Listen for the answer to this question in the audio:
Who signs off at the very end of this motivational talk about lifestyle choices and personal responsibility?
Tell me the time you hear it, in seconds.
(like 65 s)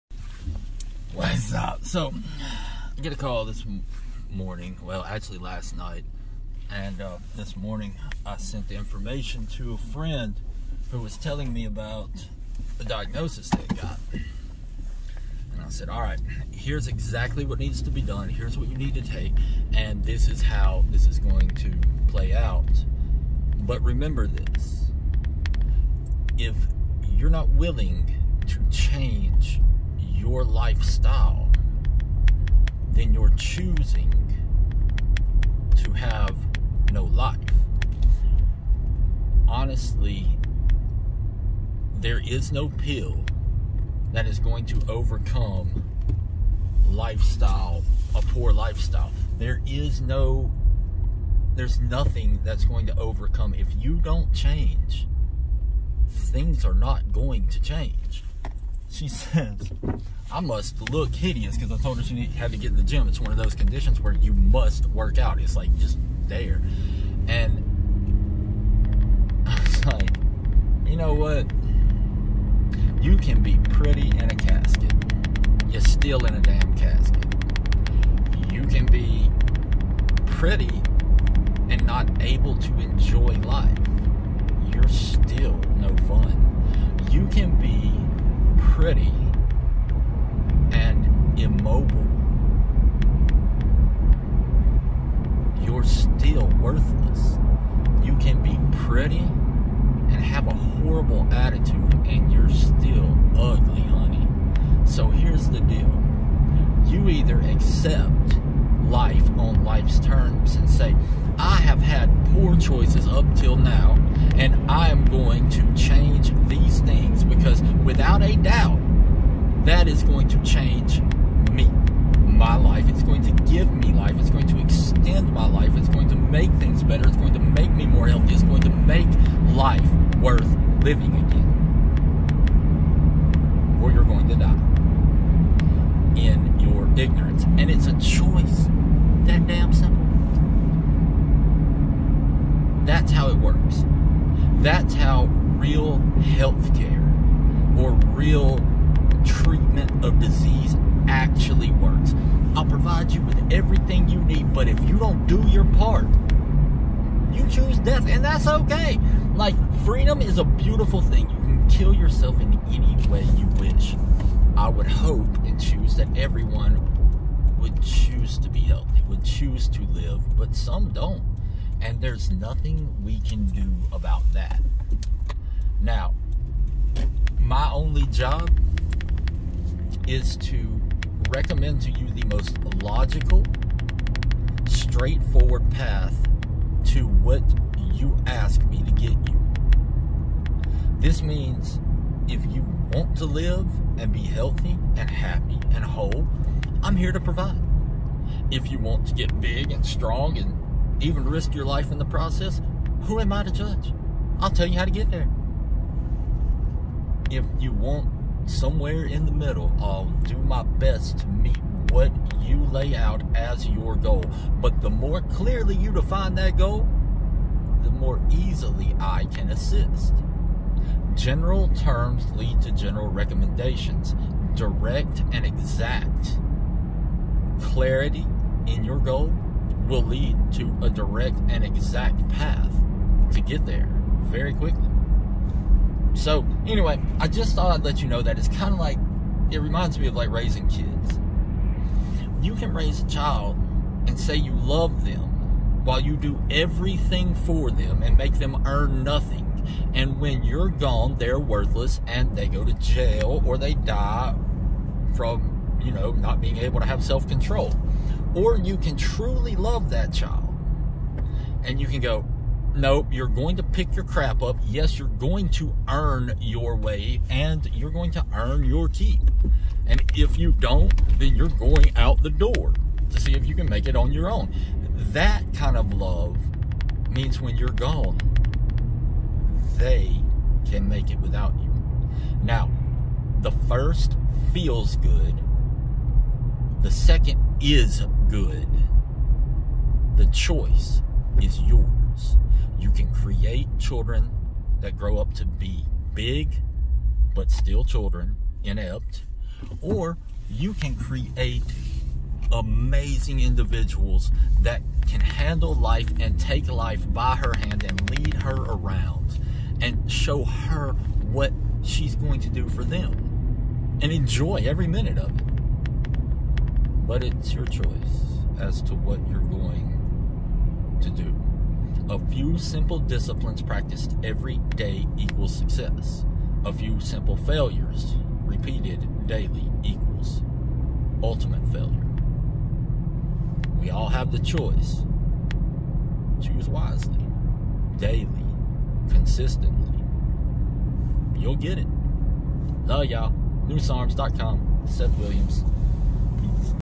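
344 s.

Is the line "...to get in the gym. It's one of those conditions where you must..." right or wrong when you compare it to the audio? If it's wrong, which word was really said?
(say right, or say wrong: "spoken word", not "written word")
right.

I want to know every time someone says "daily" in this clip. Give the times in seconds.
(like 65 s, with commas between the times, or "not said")
329 s, 337 s.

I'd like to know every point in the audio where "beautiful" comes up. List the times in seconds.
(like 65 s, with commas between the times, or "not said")
160 s.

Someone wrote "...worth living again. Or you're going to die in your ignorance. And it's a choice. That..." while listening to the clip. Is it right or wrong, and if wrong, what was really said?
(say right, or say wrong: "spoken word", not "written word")
right.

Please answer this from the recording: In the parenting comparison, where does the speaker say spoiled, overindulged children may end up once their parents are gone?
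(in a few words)
jail.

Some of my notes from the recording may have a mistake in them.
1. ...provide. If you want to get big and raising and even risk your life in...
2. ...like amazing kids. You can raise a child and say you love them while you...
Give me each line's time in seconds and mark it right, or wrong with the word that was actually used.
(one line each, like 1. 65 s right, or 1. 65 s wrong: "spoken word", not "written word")
1. 197 s wrong: "strong", not "raising"
2. 240 s wrong: "raising", not "amazing".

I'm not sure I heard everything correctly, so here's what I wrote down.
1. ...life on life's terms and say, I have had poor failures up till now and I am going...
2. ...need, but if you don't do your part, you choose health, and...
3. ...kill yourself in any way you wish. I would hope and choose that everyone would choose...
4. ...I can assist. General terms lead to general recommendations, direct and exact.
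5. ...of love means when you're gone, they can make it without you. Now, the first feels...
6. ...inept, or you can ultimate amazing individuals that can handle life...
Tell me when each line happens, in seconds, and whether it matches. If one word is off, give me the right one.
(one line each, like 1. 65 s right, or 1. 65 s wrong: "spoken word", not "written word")
1. 108 s wrong: "choices", not "failures"
2. 154 s wrong: "death", not "health"
3. 161 s right
4. 218 s right
5. 275 s right
6. 298 s wrong: "create", not "ultimate".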